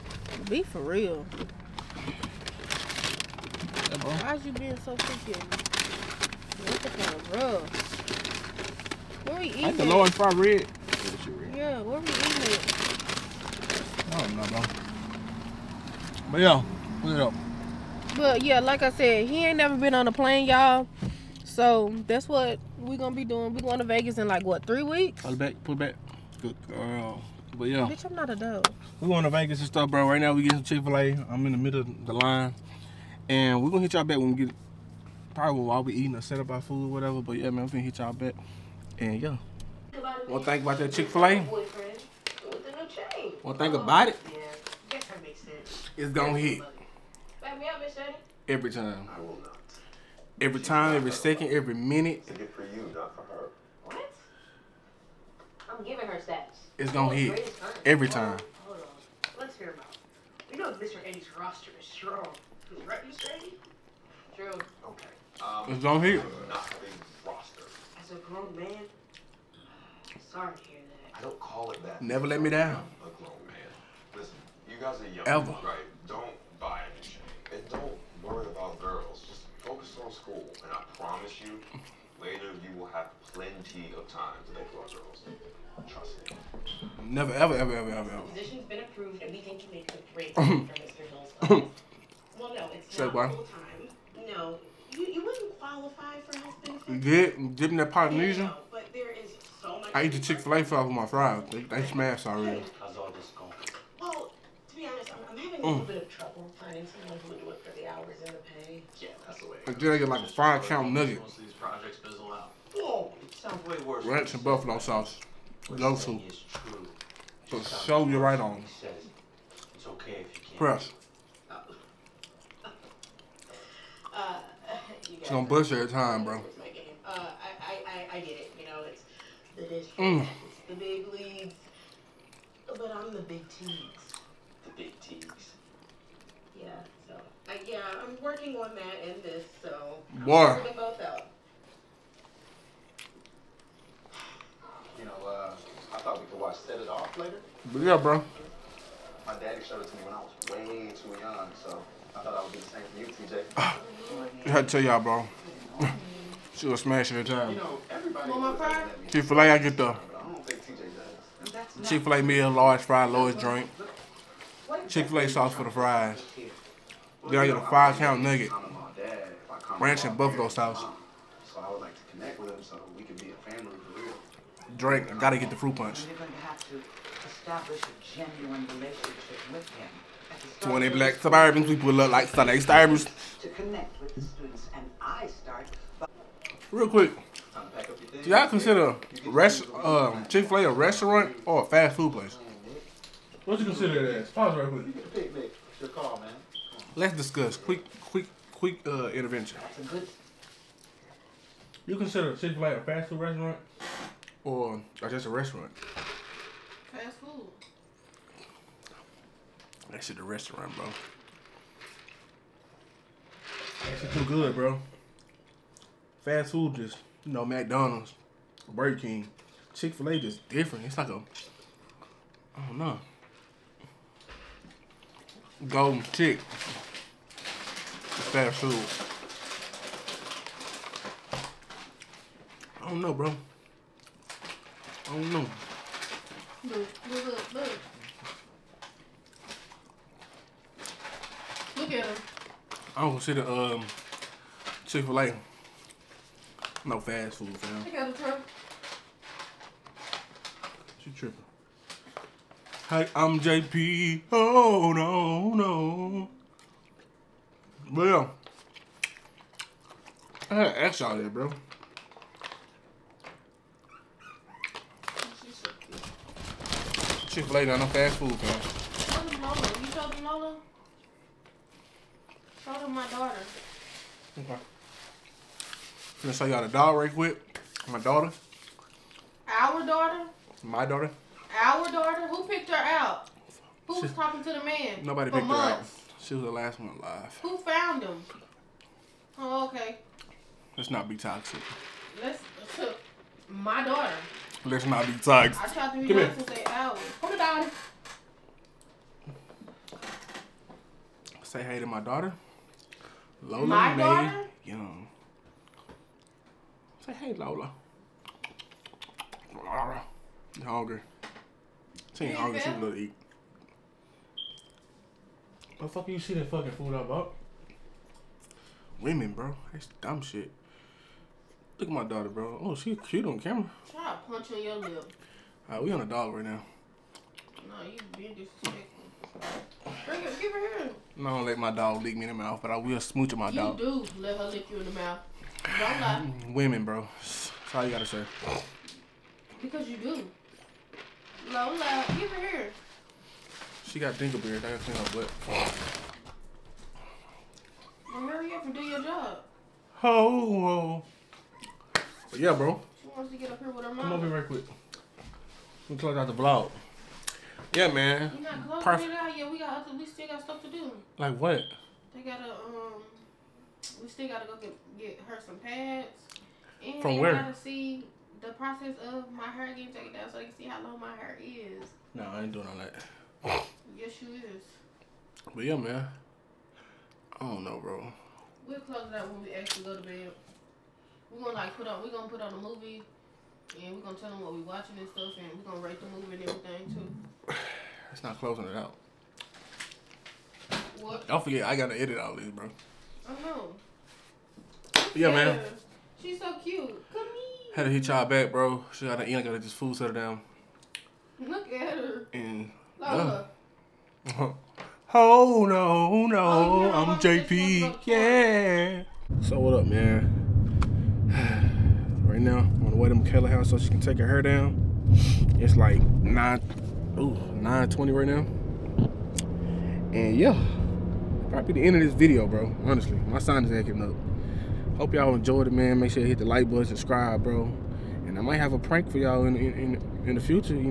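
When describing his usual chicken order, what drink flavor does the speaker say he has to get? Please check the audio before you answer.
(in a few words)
Fruit punch.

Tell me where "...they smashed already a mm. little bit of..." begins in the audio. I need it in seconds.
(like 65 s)
101 s.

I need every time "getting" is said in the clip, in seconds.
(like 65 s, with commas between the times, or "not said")
30 s, 369 s.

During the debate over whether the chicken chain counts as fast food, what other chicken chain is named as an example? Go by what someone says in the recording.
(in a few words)
Golden Chick.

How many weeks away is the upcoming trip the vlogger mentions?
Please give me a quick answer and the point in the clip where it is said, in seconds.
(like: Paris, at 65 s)
3, at 24 s.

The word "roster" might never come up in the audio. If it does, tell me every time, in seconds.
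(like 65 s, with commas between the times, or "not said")
61 s, 67 s.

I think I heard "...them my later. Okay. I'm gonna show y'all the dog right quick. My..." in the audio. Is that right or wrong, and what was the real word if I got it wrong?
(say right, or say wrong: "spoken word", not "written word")
wrong: "daughter", not "later".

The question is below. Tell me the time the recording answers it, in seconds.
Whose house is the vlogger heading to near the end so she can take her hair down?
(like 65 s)
413 s.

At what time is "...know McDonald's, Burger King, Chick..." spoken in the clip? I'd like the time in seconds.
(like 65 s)
217 s.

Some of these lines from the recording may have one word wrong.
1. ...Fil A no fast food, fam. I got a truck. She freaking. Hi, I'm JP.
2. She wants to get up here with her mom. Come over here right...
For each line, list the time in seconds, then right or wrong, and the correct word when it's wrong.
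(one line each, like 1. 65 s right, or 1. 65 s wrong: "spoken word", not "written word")
1. 245 s wrong: "tripping", not "freaking"
2. 353 s right.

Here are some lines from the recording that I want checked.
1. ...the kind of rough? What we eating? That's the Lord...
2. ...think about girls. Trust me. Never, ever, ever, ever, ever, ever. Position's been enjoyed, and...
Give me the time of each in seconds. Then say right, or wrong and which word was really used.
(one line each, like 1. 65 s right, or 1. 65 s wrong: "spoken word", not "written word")
1. 6 s right
2. 84 s wrong: "approved", not "enjoyed".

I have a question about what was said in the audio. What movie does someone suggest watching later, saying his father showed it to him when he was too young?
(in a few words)
Set It Off.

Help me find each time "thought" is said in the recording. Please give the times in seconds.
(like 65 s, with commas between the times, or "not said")
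145 s, 152 s.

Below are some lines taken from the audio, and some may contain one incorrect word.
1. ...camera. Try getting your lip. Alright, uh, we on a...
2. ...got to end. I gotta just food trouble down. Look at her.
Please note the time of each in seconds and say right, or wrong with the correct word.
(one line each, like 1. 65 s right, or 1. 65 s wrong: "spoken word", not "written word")
1. 323 s wrong: "punching", not "getting"
2. 399 s wrong: "settle", not "trouble".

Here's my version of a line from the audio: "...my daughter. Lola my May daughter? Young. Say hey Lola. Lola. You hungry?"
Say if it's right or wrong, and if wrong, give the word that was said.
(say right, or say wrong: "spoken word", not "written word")
right.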